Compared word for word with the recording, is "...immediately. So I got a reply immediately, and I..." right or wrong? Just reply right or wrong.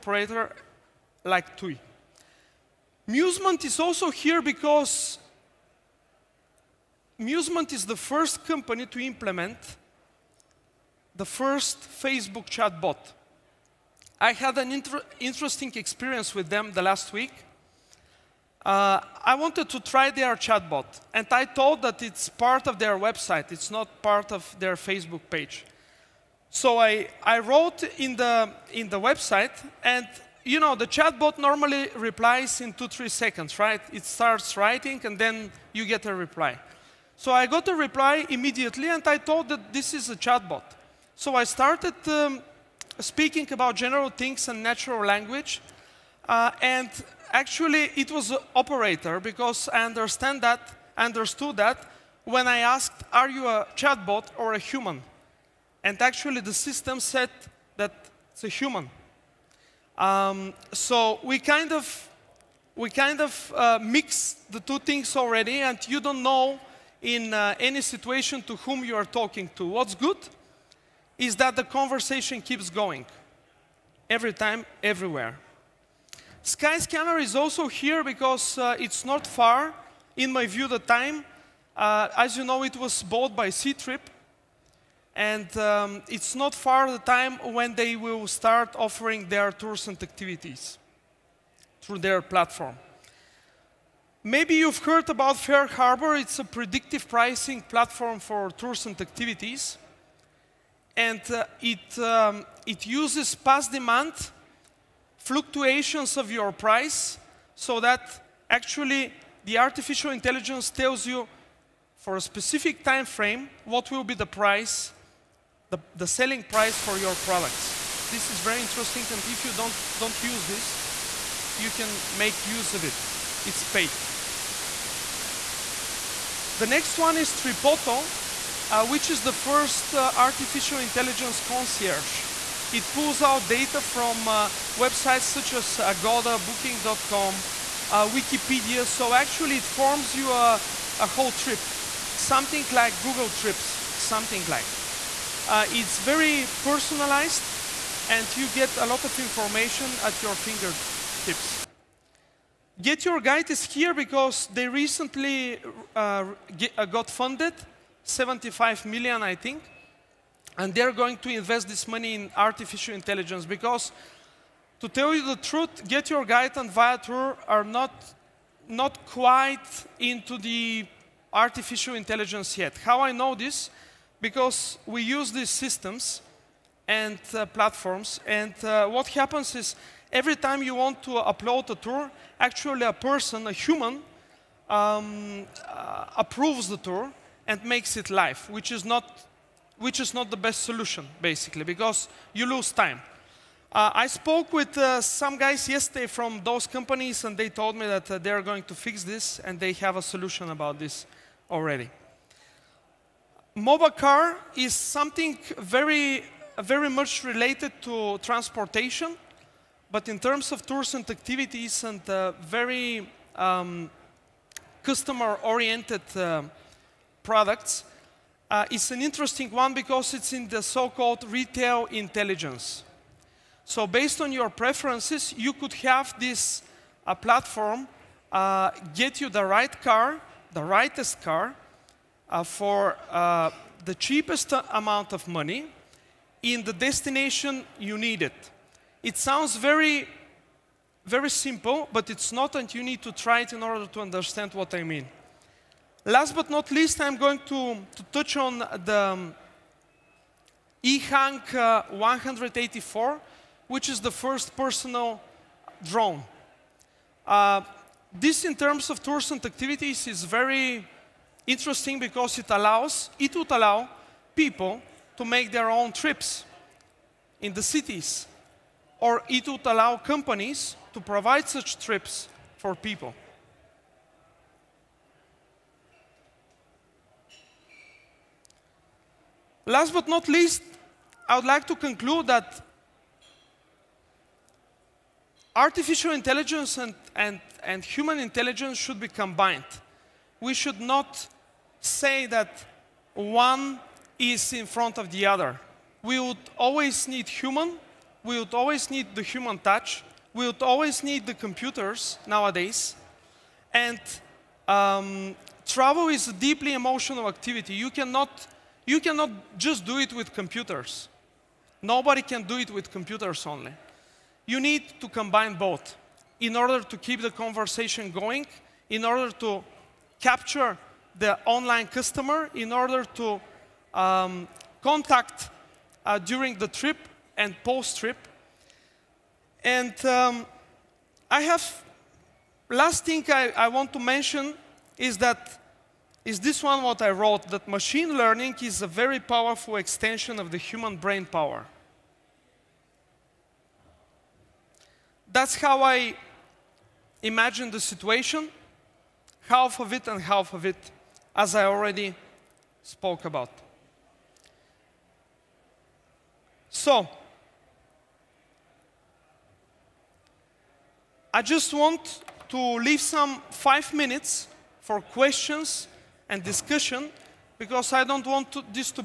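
wrong.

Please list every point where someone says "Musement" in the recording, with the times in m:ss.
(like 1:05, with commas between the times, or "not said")
0:03, 0:07.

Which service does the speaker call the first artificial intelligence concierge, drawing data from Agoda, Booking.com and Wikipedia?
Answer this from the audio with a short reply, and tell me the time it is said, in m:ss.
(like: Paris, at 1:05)
Tripoto, at 2:07.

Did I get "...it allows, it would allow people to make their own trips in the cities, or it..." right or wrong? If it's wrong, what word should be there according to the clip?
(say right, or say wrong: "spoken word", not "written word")
right.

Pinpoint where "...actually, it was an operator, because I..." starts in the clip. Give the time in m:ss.
0:47.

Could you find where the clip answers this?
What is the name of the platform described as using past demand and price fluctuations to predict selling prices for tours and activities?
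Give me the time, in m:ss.
1:35.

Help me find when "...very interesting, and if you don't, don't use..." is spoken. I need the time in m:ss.
1:58.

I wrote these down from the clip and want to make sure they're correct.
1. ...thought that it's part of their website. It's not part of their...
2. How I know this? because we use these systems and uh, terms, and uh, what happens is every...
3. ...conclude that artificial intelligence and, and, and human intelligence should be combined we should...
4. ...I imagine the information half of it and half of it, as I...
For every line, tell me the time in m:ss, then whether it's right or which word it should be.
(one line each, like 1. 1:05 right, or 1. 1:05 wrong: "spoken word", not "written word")
1. 0:21 right
2. 2:52 wrong: "platforms", not "terms"
3. 4:41 right
4. 5:45 wrong: "situation", not "information".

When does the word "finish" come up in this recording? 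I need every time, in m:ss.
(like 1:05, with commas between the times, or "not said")
not said.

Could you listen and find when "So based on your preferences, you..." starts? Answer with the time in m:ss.
3:43.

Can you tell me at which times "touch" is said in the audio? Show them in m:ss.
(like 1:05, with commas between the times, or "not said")
4:08, 4:59.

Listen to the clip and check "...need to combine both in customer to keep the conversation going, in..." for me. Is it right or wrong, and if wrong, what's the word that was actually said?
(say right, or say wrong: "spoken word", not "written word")
wrong: "order", not "customer".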